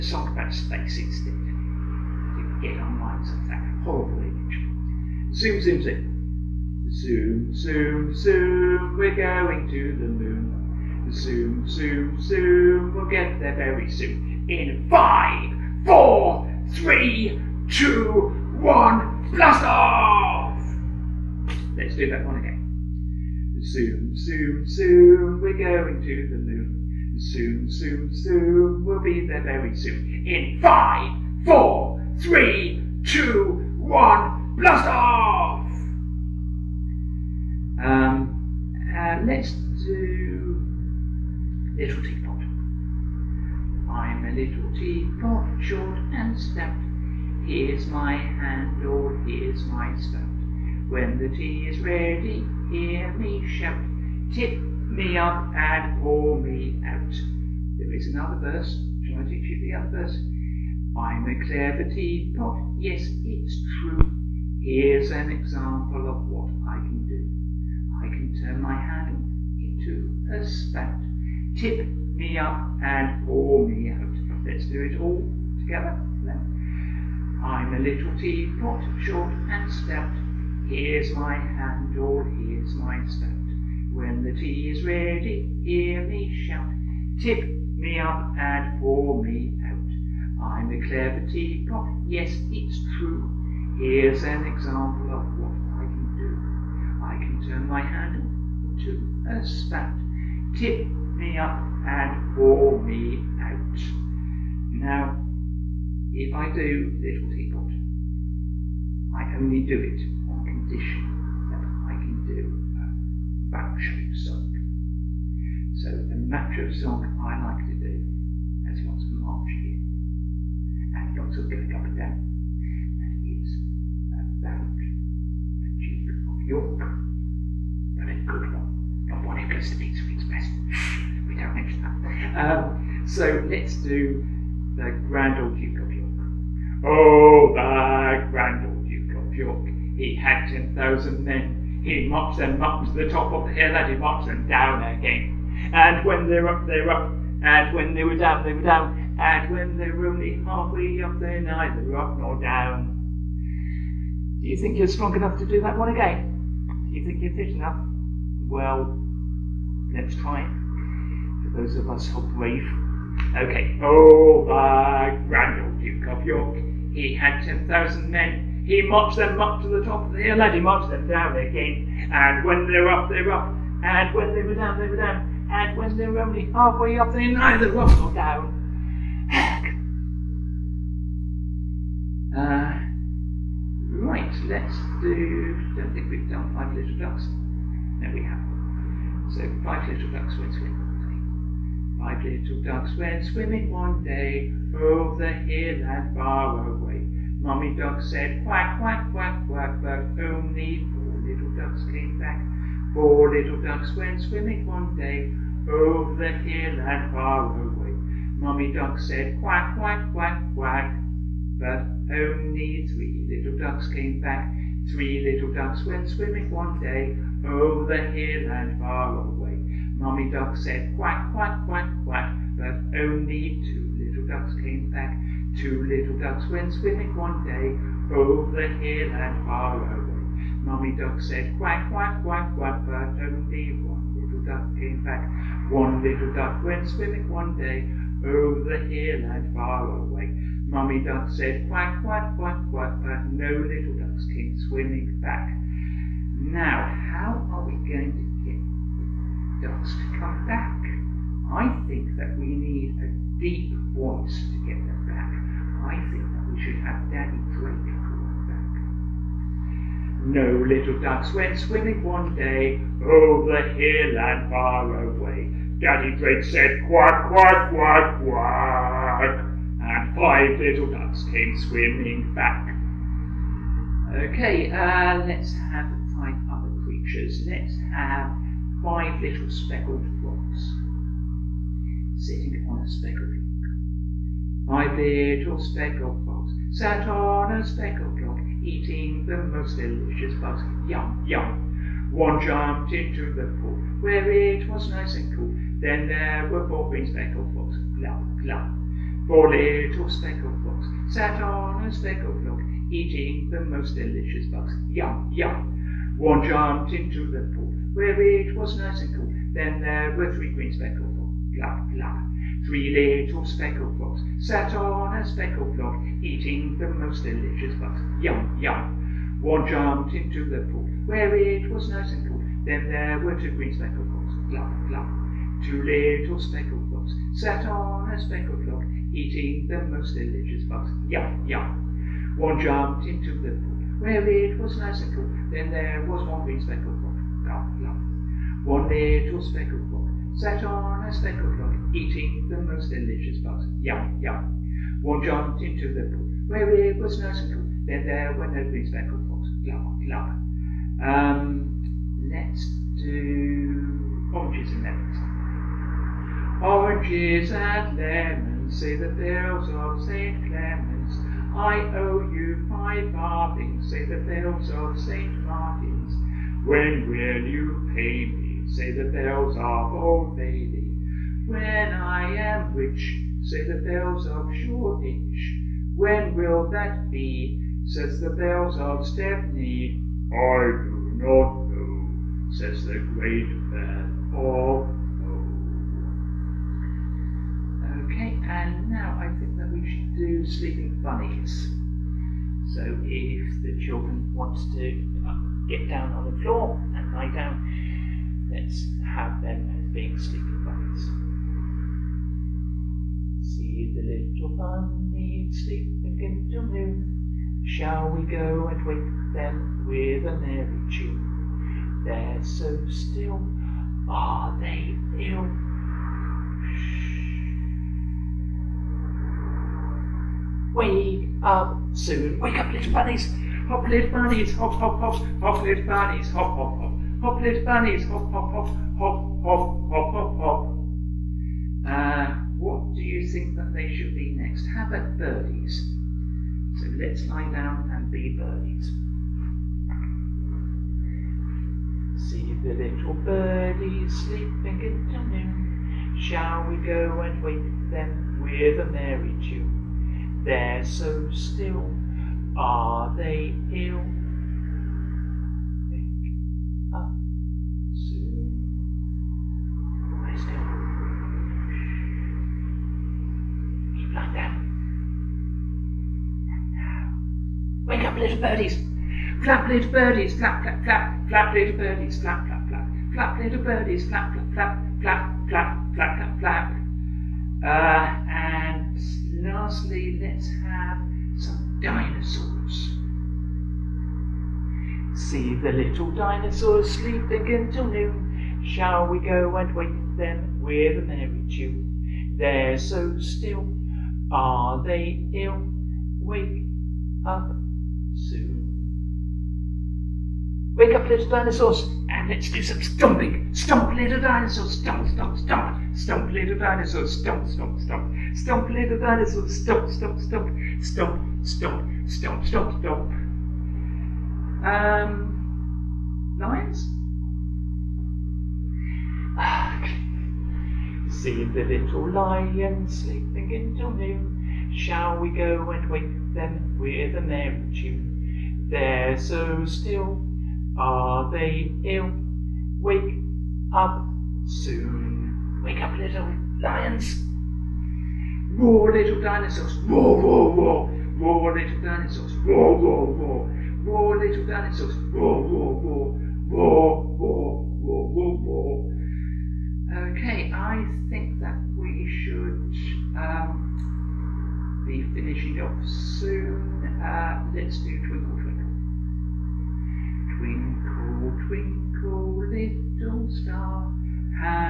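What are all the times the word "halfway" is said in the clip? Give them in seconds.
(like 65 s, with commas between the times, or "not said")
150 s, 176 s.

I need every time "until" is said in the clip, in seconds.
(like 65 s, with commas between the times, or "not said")
406 s, 487 s, 523 s.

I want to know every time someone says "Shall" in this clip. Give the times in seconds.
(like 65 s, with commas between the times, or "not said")
59 s, 407 s, 446 s, 488 s, 524 s.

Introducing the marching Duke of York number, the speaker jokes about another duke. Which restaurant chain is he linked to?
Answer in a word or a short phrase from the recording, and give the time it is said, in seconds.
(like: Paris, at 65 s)
Pizza Express, at 129 s.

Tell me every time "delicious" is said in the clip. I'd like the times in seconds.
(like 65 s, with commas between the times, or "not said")
289 s, 303 s, 317 s, 330 s, 342 s.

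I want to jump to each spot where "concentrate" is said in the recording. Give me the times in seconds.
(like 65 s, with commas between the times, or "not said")
not said.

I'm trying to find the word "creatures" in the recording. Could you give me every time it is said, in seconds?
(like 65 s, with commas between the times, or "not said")
276 s.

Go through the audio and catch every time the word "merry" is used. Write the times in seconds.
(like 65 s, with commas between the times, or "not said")
410 s, 448 s, 491 s.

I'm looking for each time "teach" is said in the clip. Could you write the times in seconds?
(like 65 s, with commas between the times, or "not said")
59 s.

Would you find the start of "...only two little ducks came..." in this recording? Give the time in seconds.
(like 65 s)
222 s.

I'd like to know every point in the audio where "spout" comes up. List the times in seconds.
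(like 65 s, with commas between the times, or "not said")
70 s, 83 s, 99 s.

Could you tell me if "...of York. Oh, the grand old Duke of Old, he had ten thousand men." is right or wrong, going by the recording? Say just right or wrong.
wrong.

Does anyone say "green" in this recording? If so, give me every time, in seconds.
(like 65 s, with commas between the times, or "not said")
296 s, 310 s, 323 s, 336 s, 348 s.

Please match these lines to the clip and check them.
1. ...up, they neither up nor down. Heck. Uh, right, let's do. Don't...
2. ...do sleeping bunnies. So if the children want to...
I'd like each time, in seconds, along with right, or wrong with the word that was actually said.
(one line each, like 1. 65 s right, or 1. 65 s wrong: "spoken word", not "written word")
1. 176 s right
2. 390 s right.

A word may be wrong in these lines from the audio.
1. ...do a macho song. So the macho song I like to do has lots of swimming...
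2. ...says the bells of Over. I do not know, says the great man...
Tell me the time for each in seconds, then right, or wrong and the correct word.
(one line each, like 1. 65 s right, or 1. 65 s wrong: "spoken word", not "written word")
1. 112 s wrong: "marching", not "swimming"
2. 377 s wrong: "Stepney", not "Over".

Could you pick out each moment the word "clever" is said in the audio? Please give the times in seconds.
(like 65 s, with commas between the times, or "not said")
61 s, 90 s.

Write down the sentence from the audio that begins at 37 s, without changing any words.
Um, uh, let's do little teapot.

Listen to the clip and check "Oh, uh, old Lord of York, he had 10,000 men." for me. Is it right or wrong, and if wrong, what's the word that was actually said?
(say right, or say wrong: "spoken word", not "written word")
wrong: "Duke", not "Lord".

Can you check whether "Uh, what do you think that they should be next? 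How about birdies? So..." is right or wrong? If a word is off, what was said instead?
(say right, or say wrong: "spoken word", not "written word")
right.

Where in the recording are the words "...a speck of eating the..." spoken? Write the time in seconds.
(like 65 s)
341 s.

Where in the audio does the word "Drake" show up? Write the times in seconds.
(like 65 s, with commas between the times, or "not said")
257 s, 266 s.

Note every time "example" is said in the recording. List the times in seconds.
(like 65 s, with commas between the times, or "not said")
65 s, 94 s.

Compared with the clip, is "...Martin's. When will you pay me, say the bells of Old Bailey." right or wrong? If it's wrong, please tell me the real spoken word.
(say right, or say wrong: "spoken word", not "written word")
right.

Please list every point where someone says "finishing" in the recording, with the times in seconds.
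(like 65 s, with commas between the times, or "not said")
555 s.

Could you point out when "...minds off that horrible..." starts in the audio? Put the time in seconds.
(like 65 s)
2 s.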